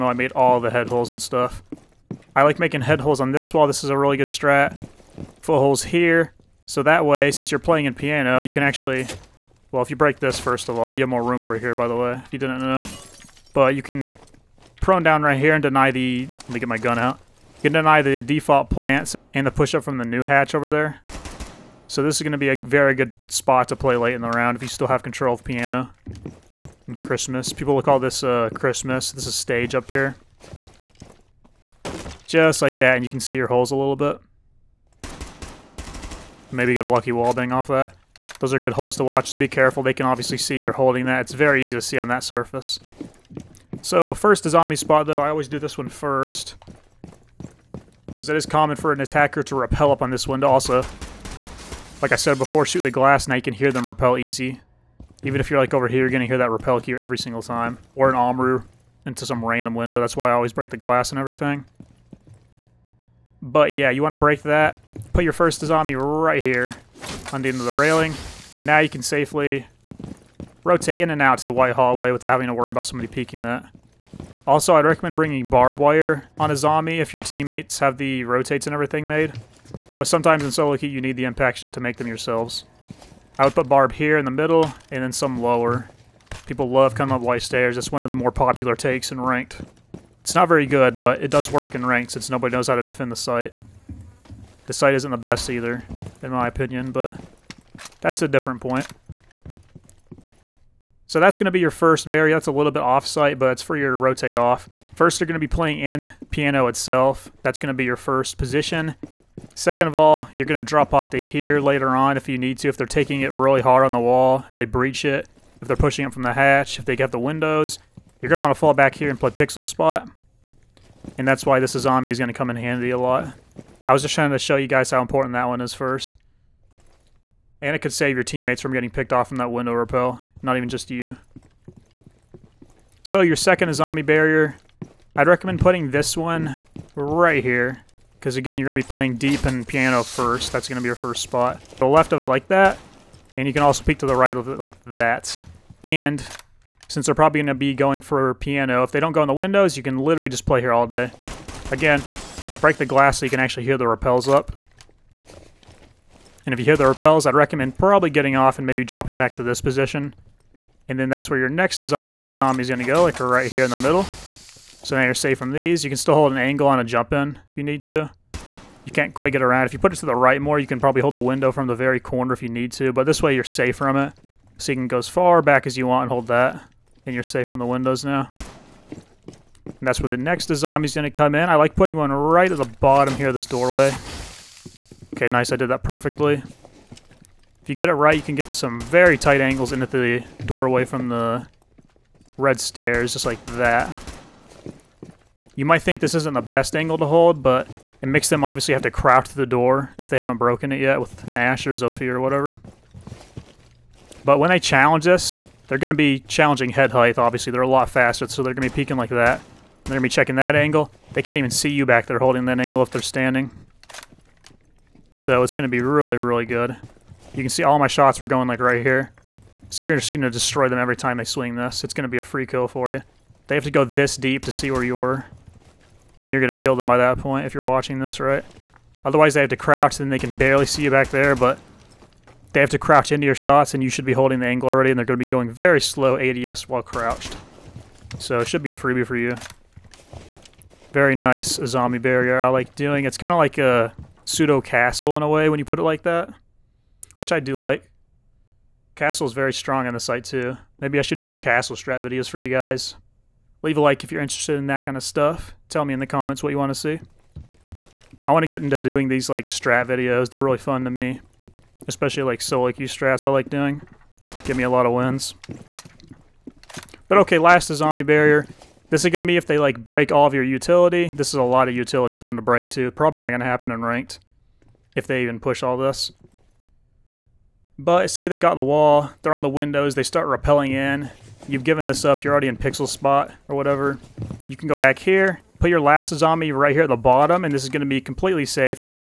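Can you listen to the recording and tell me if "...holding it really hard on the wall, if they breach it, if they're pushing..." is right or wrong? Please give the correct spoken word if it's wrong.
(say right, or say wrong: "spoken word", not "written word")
wrong: "taking", not "holding".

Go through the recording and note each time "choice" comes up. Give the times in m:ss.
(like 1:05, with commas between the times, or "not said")
not said.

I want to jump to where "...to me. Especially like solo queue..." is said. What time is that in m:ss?
4:20.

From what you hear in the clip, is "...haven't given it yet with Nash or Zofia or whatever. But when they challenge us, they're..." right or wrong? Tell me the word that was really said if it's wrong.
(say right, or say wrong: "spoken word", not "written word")
wrong: "broken", not "given".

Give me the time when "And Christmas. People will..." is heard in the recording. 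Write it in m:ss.
0:26.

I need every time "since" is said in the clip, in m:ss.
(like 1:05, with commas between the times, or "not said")
0:07, 1:32, 2:26.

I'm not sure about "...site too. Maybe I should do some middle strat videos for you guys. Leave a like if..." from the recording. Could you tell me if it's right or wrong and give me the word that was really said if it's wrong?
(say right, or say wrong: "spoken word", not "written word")
wrong: "castle", not "middle".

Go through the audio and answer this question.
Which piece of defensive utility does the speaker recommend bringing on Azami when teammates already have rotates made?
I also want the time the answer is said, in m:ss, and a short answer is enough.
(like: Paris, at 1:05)
Barbed wire, at 1:15.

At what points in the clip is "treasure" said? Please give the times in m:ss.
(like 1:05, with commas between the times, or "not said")
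not said.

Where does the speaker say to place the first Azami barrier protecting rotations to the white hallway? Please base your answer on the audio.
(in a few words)
End of the railing.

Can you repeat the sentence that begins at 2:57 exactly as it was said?
And you're safe from the windows now.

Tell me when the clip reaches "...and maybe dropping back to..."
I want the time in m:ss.
2:38.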